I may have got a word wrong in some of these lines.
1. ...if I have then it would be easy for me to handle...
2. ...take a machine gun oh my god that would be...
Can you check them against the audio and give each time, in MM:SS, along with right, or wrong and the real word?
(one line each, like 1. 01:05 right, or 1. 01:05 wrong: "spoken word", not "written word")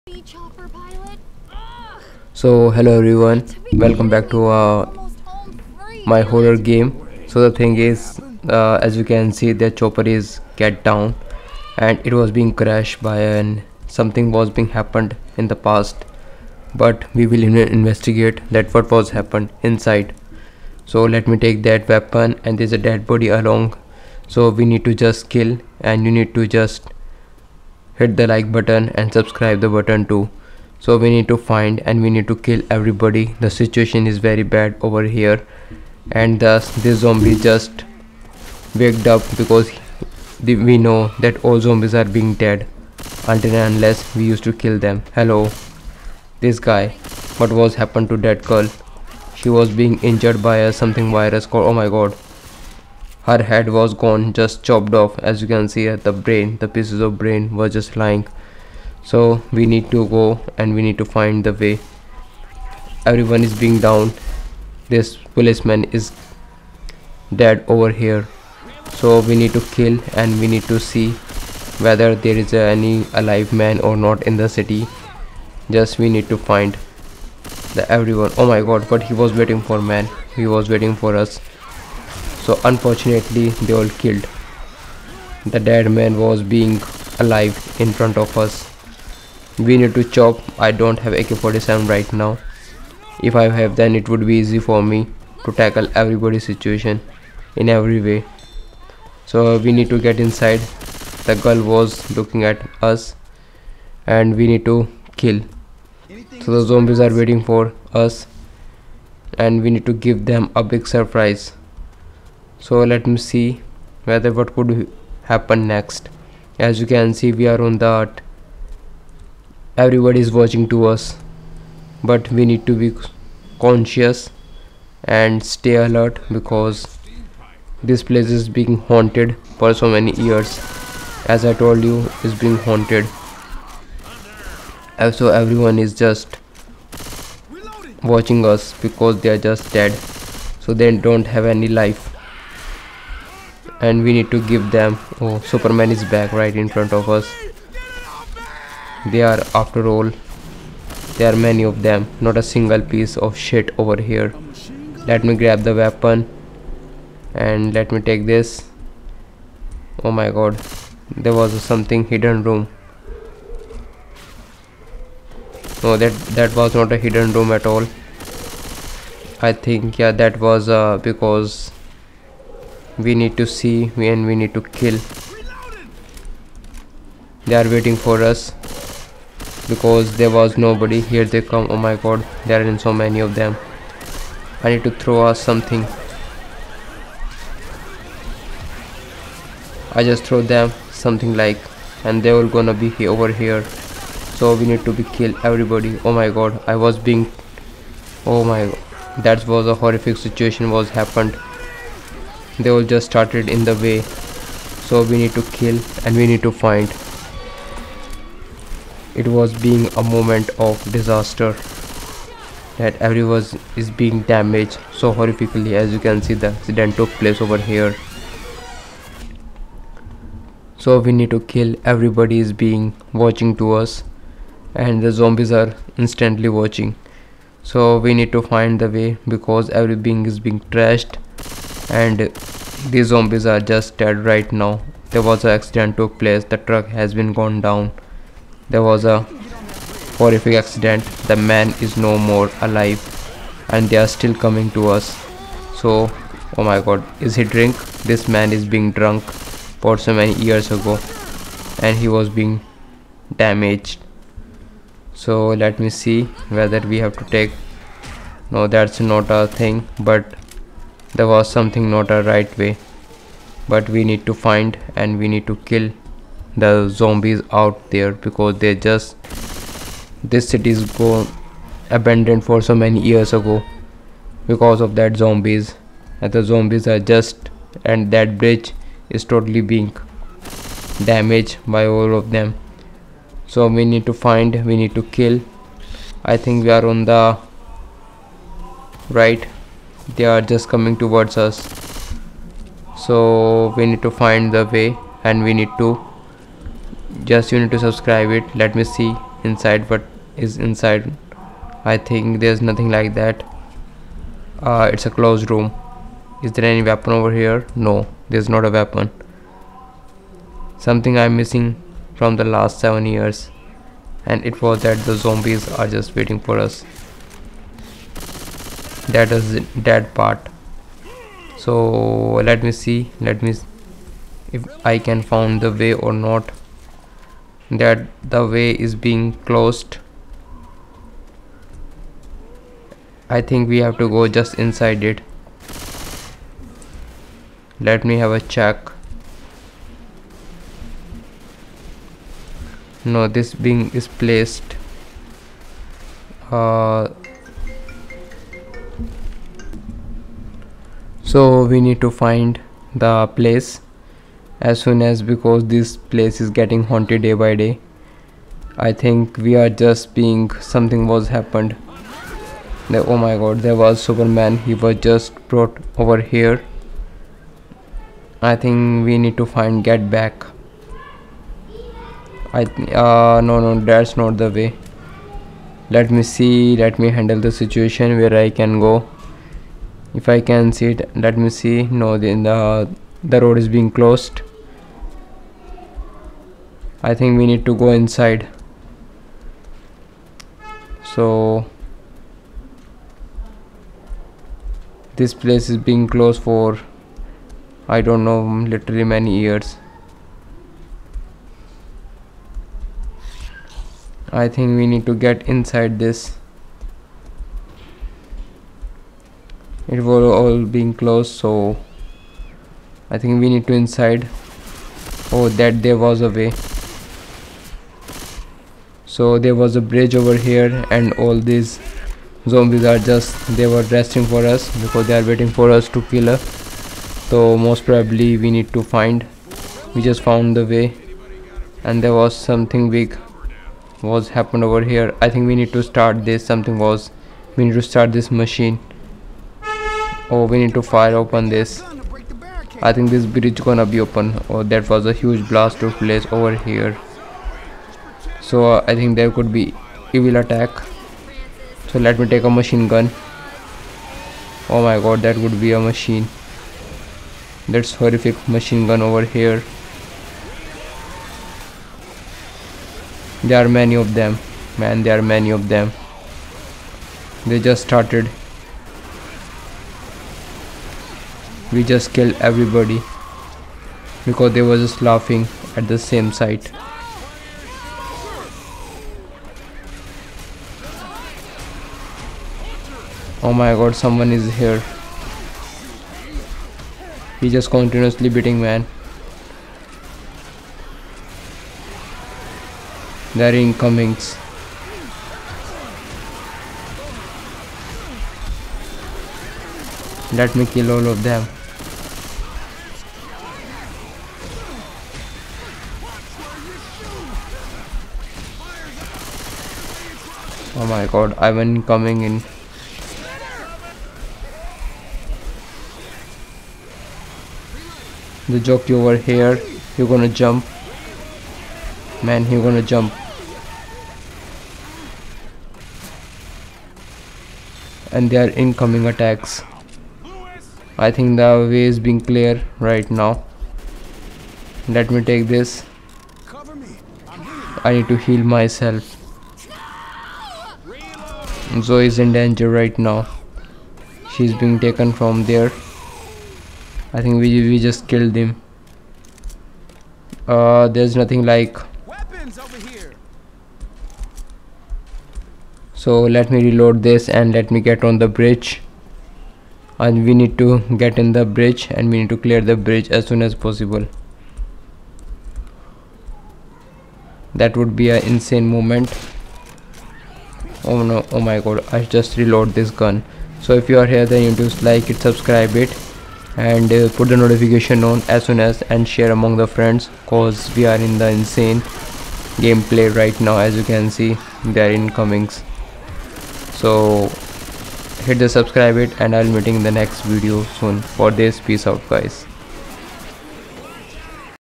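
1. 01:33 wrong: "tackle", not "handle"
2. 07:32 right.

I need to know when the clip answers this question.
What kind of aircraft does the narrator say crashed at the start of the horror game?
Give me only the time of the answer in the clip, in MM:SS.
00:09.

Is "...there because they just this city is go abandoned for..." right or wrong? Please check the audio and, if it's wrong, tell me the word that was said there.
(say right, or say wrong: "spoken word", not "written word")
right.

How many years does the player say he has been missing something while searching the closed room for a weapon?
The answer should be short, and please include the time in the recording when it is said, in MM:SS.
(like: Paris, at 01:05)
7, at 05:12.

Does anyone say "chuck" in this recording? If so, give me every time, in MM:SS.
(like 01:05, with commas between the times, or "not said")
not said.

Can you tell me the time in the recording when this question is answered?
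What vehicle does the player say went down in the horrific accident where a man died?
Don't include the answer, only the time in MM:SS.
03:56.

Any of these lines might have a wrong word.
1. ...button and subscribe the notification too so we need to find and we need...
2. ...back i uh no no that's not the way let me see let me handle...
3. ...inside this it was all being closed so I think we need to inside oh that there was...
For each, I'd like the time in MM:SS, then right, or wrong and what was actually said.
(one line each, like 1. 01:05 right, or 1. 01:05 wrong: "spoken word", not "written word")
1. 00:28 wrong: "button", not "notification"
2. 06:10 right
3. 06:45 right.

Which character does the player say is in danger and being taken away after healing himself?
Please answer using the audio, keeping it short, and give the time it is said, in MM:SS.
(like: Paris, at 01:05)
Zoey, at 09:01.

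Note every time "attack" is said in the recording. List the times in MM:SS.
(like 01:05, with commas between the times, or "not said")
07:30, 08:49.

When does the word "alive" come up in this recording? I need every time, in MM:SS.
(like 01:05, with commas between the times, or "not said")
01:13, 01:27, 04:02.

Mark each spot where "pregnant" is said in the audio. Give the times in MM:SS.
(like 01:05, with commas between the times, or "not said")
not said.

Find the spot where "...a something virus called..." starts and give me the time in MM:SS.
00:50.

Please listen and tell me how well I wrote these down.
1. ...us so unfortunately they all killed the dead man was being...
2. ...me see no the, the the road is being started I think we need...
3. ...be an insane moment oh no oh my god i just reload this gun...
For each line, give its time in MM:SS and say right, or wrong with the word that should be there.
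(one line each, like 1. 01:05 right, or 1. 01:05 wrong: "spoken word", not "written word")
1. 01:21 right
2. 06:21 wrong: "closed", not "started"
3. 09:27 right.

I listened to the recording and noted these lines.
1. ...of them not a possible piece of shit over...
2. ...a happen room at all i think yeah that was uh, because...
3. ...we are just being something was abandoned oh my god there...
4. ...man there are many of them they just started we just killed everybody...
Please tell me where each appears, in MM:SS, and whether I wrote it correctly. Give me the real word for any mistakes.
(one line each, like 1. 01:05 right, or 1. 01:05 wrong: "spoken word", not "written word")
1. 02:31 wrong: "single", not "possible"
2. 02:46 wrong: "hidden", not "happen"
3. 05:59 wrong: "happened", not "abandoned"
4. 07:44 right.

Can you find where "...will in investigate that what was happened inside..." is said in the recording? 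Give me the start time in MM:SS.
00:17.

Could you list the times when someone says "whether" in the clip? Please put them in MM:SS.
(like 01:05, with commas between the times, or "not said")
01:11, 01:54, 04:16.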